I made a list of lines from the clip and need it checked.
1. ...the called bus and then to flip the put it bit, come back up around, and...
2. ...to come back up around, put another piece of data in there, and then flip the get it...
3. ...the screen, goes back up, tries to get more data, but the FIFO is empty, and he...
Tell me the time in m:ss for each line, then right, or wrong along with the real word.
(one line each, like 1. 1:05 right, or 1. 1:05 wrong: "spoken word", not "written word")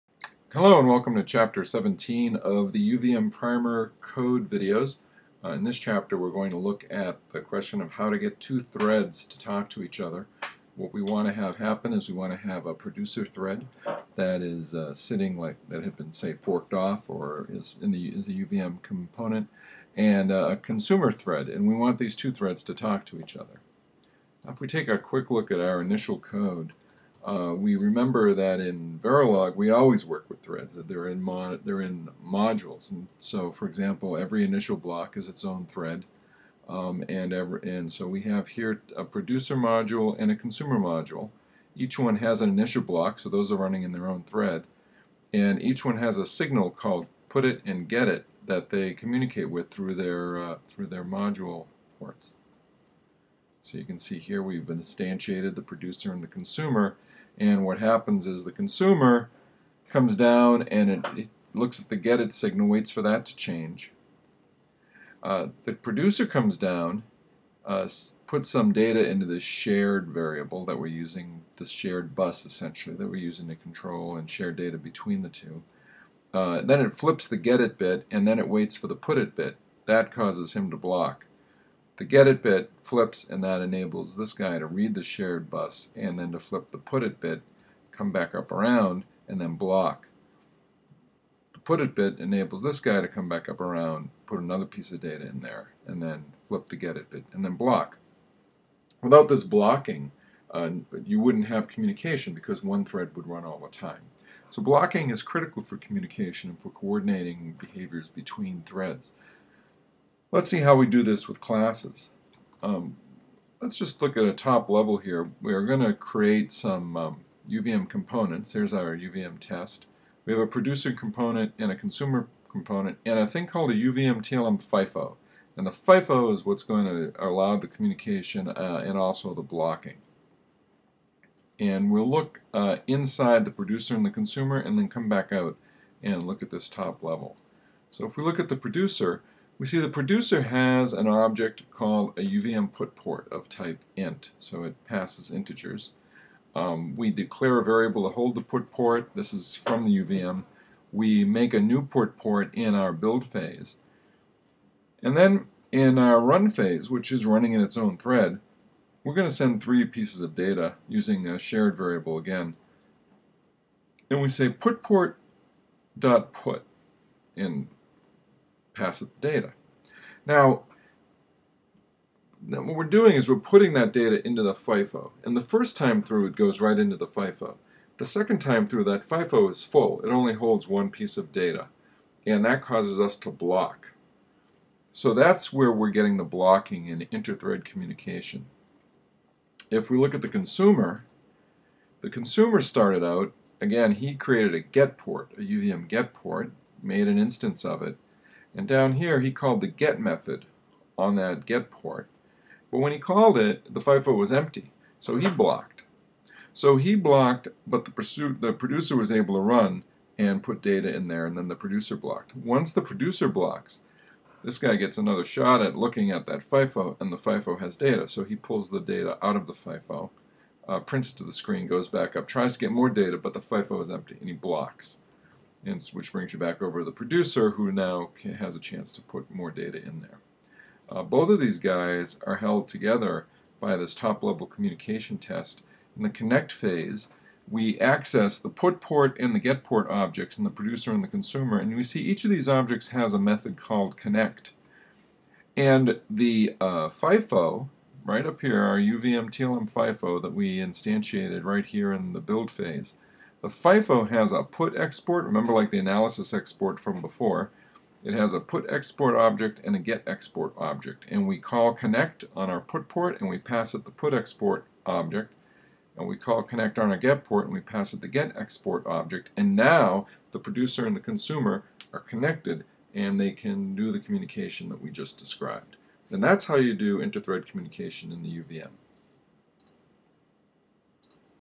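1. 1:24 wrong: "shared", not "called"
2. 1:33 right
3. 3:41 right.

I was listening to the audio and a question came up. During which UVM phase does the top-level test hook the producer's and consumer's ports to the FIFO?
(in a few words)
connect phase.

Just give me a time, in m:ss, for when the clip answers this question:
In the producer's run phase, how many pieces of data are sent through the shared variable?
2:39.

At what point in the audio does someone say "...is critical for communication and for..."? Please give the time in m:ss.
1:45.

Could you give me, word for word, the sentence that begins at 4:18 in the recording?
It has a put export object and a get export object.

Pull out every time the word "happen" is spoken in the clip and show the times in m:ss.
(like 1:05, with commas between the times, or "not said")
0:11, 0:57.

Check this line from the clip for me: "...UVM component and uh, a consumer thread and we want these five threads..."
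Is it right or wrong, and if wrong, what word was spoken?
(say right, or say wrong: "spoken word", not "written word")
wrong: "two", not "five".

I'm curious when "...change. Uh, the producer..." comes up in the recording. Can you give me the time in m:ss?
1:03.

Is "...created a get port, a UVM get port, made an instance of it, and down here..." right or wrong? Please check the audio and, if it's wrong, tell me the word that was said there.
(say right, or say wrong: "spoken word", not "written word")
right.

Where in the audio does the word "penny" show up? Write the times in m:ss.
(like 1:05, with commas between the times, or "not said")
not said.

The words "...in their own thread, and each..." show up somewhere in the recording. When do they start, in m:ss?
0:43.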